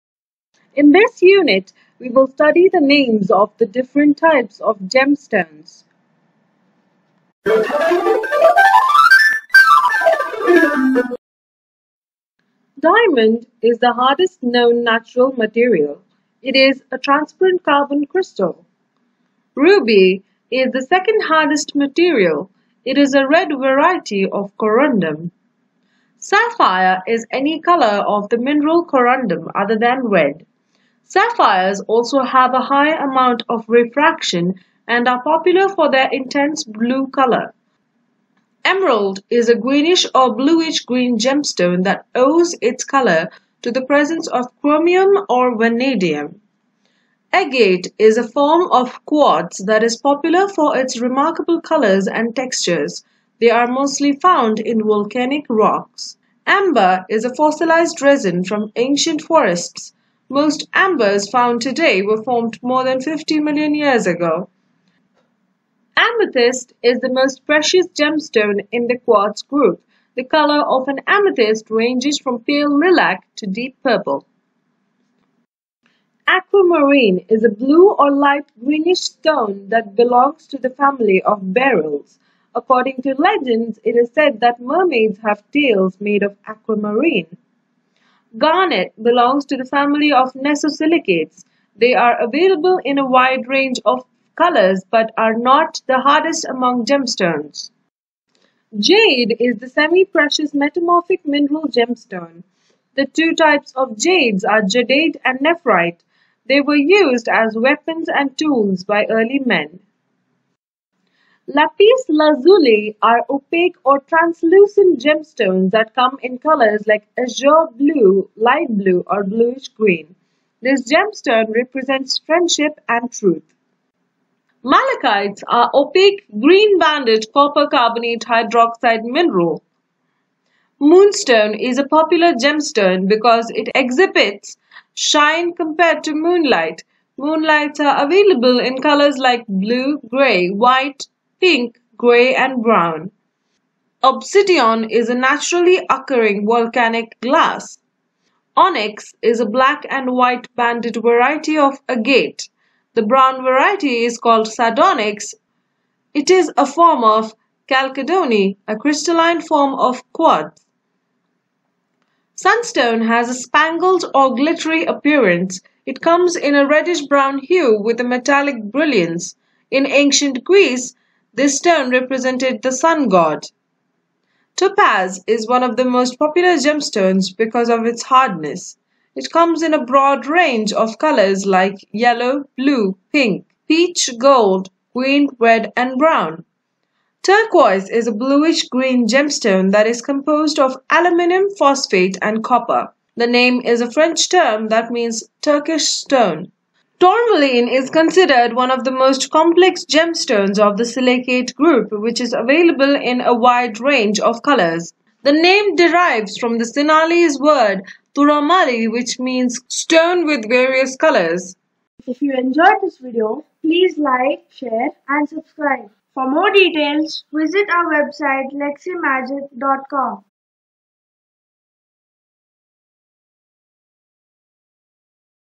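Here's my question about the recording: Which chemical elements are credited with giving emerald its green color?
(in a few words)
chromium or vanadium.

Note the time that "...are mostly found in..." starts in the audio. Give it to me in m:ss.
0:53.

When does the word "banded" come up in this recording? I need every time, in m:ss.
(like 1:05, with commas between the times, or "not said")
2:06, 2:30.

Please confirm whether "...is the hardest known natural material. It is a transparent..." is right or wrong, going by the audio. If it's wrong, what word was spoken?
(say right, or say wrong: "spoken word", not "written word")
right.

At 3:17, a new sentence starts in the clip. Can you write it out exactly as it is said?
Tourmaline is considered one of the most complex gemstones of the silicate group, which is available in a wide range of colors.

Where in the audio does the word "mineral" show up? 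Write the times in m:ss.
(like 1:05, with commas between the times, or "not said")
0:28, 1:41, 2:09.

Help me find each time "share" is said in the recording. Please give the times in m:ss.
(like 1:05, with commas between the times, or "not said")
3:34.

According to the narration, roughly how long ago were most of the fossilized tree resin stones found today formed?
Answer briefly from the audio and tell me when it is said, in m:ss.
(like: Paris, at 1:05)
more than 50 million years ago, at 1:02.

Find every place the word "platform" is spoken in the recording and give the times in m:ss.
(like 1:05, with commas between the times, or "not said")
not said.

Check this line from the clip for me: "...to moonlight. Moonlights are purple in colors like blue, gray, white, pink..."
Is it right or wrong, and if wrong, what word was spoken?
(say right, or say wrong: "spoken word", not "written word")
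wrong: "available", not "purple".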